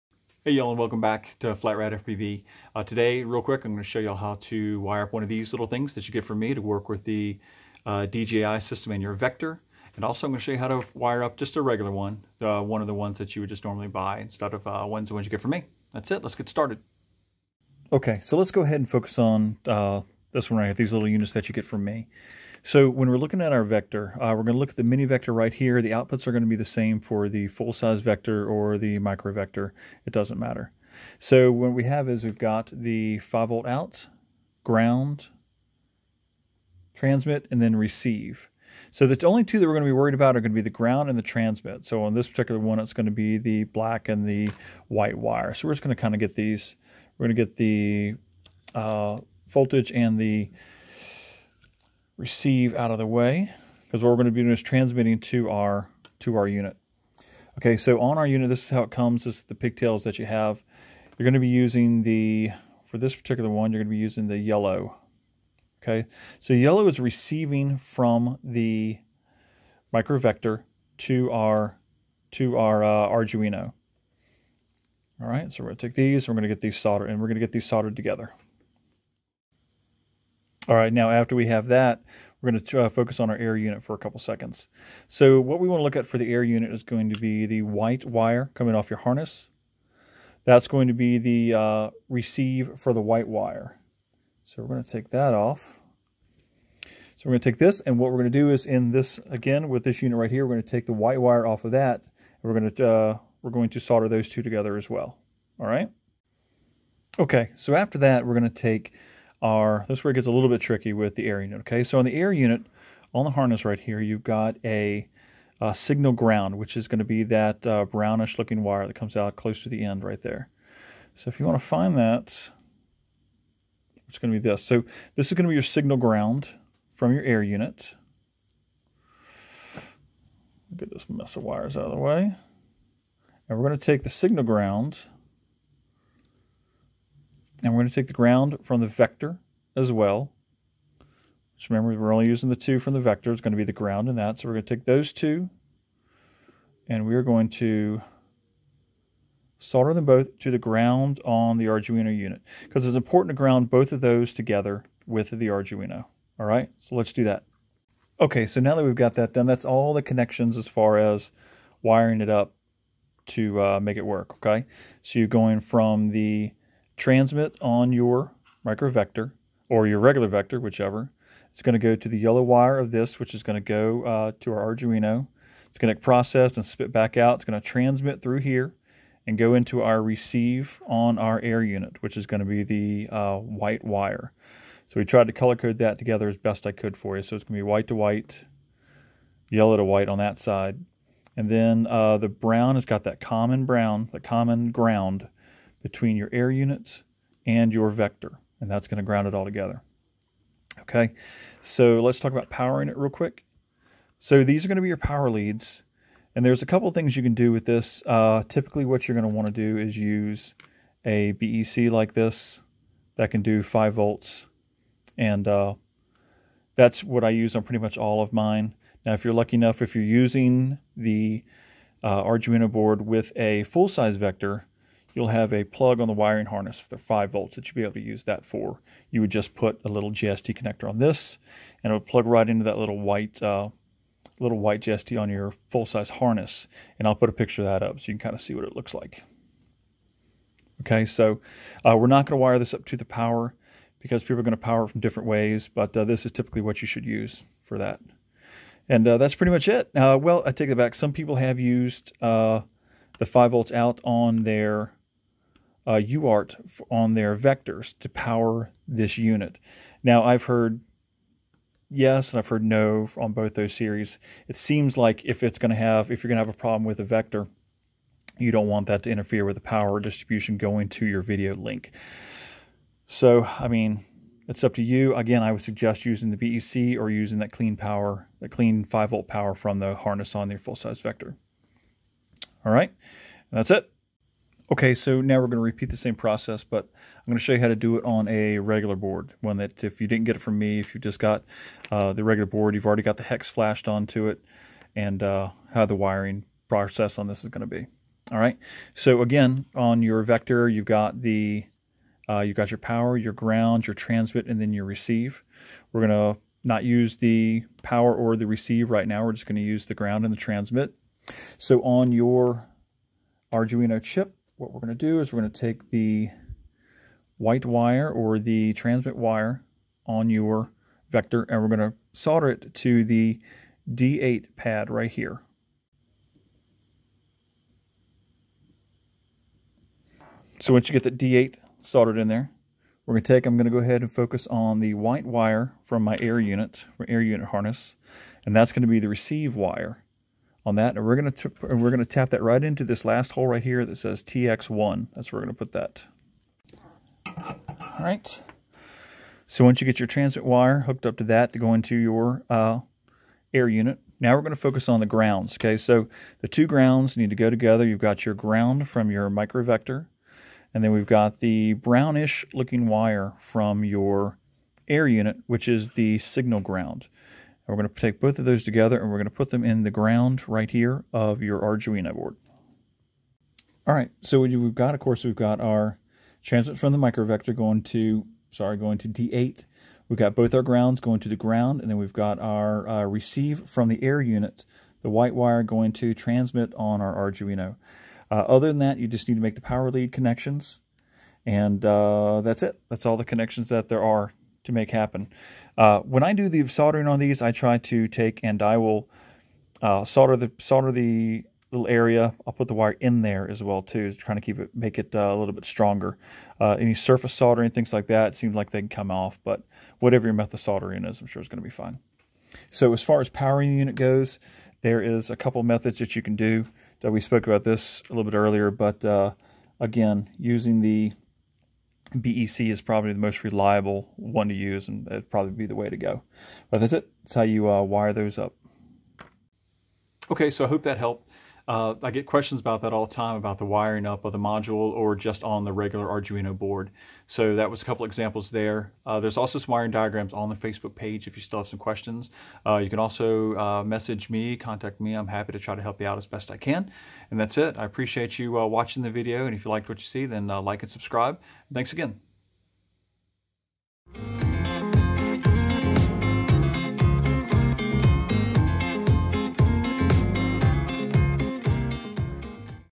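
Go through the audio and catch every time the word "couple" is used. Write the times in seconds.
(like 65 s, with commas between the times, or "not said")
83 s, 206 s, 415 s, 437 s.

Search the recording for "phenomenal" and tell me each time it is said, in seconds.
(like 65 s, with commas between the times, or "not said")
not said.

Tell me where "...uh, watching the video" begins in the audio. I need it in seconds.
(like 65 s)
448 s.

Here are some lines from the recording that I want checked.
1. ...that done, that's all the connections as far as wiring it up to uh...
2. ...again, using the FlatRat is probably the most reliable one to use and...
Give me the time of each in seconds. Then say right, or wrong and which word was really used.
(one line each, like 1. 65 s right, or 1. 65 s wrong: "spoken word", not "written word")
1. 159 s right
2. 419 s wrong: "BEC", not "FlatRat".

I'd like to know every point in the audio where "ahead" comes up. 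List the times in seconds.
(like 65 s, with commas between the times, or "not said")
18 s, 333 s.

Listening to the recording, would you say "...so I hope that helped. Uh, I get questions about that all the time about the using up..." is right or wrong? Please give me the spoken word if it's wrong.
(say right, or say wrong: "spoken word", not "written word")
wrong: "wiring", not "using".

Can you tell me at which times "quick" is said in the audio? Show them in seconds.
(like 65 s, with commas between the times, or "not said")
3 s, 203 s.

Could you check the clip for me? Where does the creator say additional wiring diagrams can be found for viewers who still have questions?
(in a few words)
Facebook page.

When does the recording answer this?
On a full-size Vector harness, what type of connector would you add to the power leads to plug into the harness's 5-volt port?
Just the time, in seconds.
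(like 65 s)
230 s.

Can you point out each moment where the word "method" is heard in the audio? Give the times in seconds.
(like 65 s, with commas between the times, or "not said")
410 s, 415 s.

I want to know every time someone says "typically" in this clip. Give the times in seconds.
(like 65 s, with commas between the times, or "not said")
208 s, 246 s.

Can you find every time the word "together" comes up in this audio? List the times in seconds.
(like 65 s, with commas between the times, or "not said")
77 s, 104 s, 154 s, 185 s, 199 s, 357 s, 368 s.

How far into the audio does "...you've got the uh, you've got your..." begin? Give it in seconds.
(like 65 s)
300 s.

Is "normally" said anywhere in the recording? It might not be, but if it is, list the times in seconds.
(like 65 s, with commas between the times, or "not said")
13 s.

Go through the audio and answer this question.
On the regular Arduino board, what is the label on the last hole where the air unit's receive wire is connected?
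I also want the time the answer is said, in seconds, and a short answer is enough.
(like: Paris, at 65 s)
TX1, at 344 s.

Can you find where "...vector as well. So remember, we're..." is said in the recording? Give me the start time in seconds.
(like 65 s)
138 s.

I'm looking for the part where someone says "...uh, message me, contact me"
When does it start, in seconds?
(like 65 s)
443 s.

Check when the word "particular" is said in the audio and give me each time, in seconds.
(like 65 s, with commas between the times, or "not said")
42 s, 63 s.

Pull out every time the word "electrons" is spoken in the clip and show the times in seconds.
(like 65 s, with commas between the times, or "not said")
not said.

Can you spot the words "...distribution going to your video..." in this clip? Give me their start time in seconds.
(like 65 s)
269 s.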